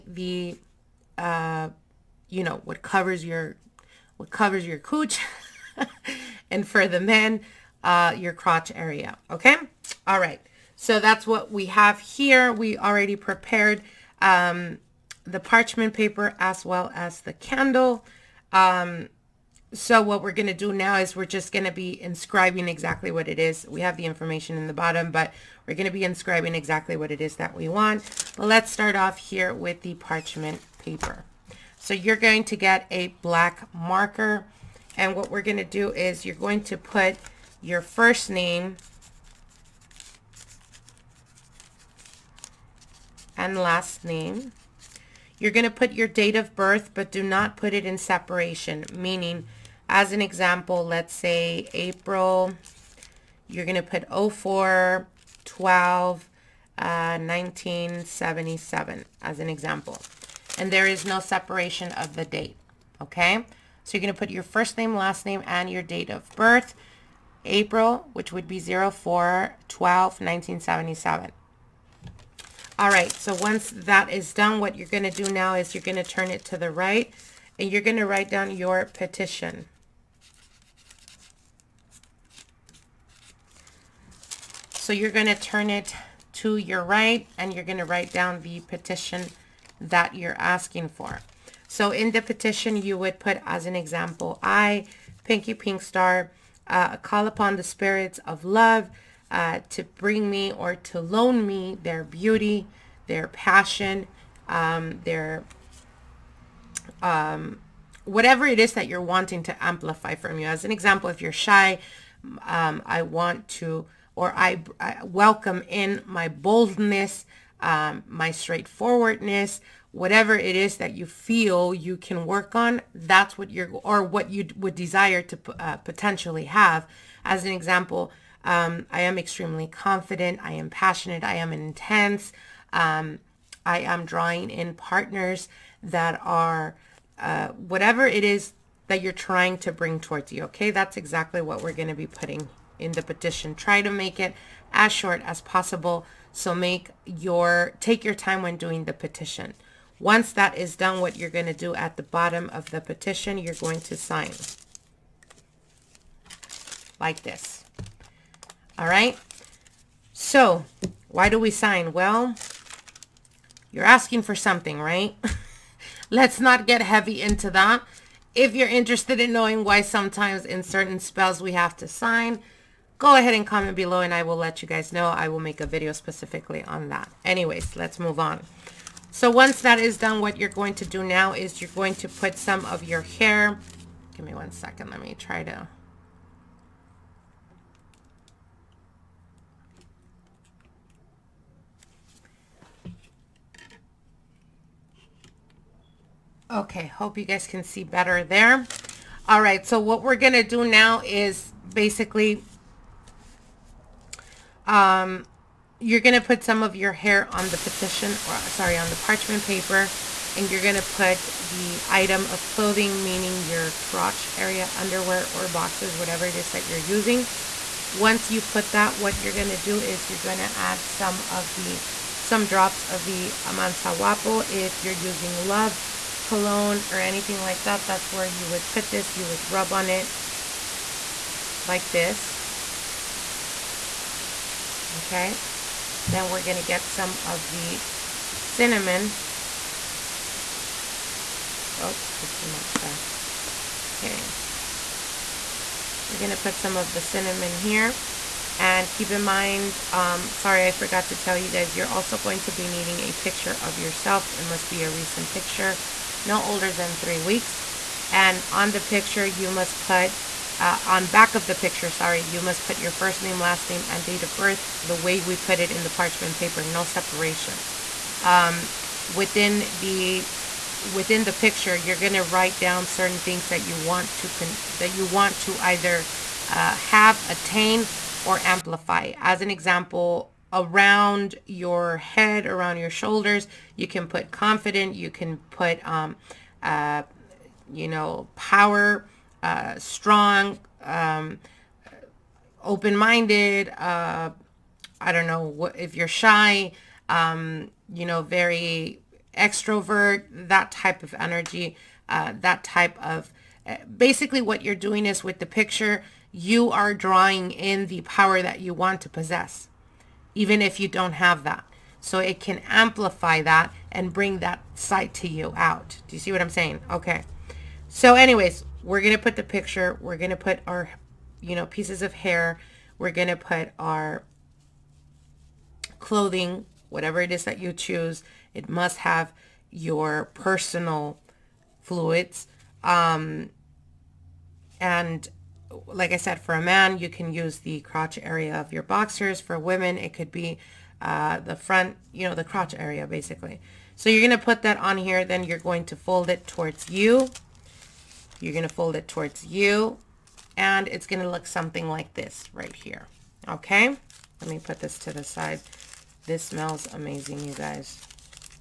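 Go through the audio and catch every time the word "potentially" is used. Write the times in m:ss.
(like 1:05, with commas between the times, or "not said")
2:05.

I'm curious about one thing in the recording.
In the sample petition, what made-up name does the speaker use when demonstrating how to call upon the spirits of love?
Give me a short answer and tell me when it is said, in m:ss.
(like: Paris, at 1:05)
Pinky Pinkstar, at 1:35.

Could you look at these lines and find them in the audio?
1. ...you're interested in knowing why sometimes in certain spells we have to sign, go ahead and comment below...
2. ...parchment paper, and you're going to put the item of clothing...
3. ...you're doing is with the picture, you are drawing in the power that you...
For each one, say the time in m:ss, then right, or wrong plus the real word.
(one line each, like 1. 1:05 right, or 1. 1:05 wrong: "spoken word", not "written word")
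1. 2:48 right
2. 3:28 right
3. 5:04 right.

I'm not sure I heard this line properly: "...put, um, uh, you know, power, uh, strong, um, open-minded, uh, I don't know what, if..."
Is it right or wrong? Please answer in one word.
right.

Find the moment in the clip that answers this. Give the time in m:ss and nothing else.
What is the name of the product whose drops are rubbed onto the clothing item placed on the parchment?
3:43.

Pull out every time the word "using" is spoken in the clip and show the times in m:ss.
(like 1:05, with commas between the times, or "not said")
3:36, 3:44.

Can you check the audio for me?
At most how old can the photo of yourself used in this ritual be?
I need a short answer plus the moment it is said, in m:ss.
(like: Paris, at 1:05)
3 weeks, at 4:16.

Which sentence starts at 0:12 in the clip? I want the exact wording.
We already prepared um, the parchment paper as well as the candle.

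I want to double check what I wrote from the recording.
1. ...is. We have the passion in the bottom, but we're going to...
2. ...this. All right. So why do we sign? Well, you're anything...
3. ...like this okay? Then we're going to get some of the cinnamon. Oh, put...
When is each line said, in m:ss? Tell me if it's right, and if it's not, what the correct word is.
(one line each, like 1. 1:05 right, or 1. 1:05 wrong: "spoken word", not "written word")
1. 0:23 wrong: "information", not "passion"
2. 2:37 wrong: "asking", not "anything"
3. 3:51 right.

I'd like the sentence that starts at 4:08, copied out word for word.
And keep in mind, um, sorry, I forgot to tell you guys, you're also going to be needing a picture of yourself.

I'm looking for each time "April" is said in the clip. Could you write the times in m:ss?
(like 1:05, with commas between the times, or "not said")
0:51, 1:07.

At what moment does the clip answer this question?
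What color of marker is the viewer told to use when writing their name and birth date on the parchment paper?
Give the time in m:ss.
0:33.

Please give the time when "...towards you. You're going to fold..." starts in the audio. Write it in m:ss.
5:46.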